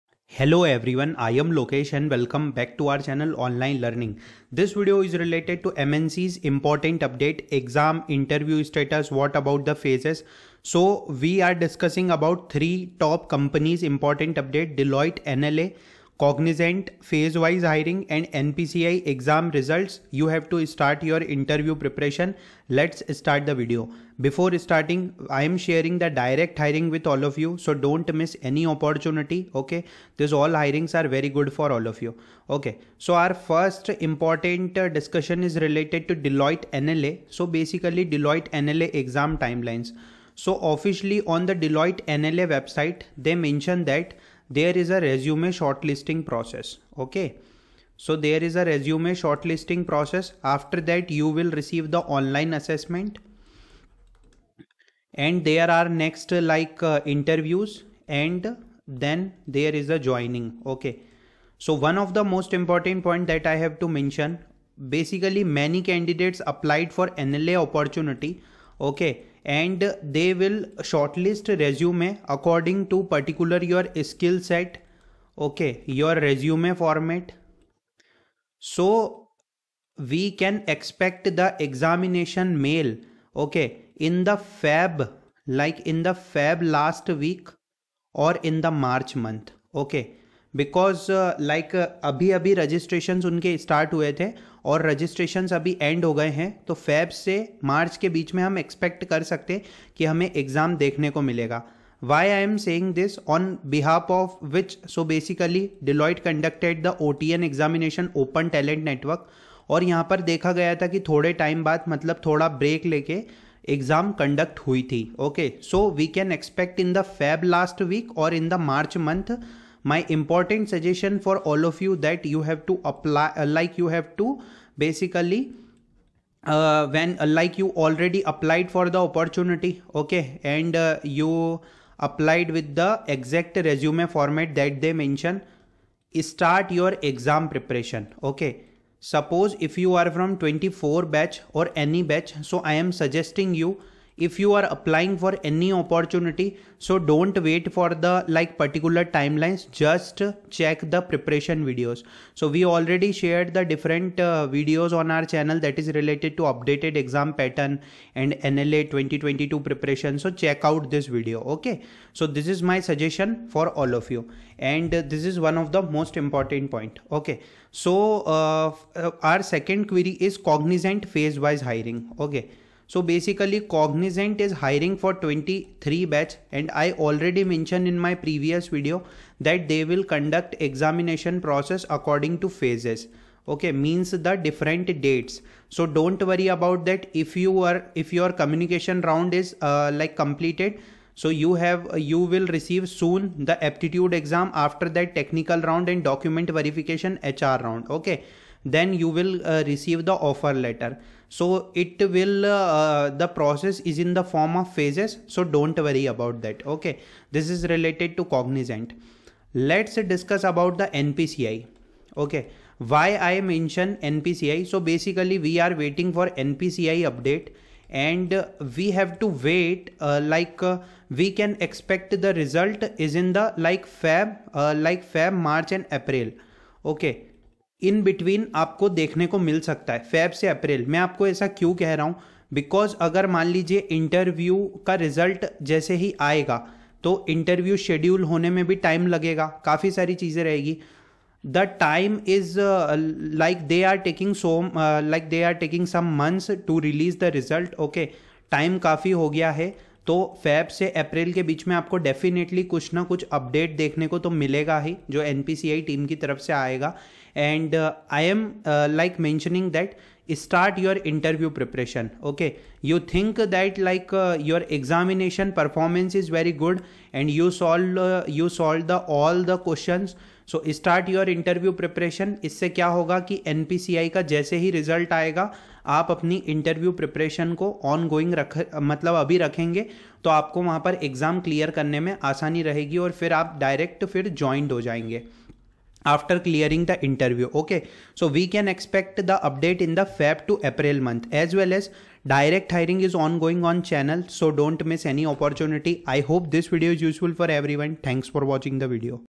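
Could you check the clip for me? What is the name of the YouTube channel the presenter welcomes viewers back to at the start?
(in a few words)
Online Learning.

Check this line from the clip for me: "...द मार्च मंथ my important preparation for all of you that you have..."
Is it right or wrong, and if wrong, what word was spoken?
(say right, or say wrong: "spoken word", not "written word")
wrong: "suggestion", not "preparation".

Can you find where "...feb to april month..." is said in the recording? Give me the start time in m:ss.
4:50.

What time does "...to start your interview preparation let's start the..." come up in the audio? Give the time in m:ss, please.
0:20.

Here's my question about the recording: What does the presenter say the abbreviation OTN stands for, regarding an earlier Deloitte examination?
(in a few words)
Open Talent Network.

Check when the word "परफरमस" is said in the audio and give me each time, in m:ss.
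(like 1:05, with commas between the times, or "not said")
4:25.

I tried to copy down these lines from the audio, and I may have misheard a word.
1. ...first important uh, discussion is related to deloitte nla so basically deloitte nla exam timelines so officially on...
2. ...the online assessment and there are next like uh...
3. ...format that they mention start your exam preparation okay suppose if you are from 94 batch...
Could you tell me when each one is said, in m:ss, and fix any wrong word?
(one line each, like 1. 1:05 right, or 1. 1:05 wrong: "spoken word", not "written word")
1. 0:33 right
2. 0:51 right
3. 2:14 wrong: "24", not "94".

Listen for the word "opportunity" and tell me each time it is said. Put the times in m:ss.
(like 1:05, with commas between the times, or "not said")
0:28, 1:07, 2:08, 2:25, 4:55.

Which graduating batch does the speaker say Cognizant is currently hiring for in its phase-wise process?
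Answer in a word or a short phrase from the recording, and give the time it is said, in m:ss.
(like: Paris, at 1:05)
2023 batch, at 2:55.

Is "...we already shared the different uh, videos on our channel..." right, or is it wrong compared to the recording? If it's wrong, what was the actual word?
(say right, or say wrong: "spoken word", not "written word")
right.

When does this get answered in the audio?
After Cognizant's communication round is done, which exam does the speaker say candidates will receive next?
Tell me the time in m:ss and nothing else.
3:13.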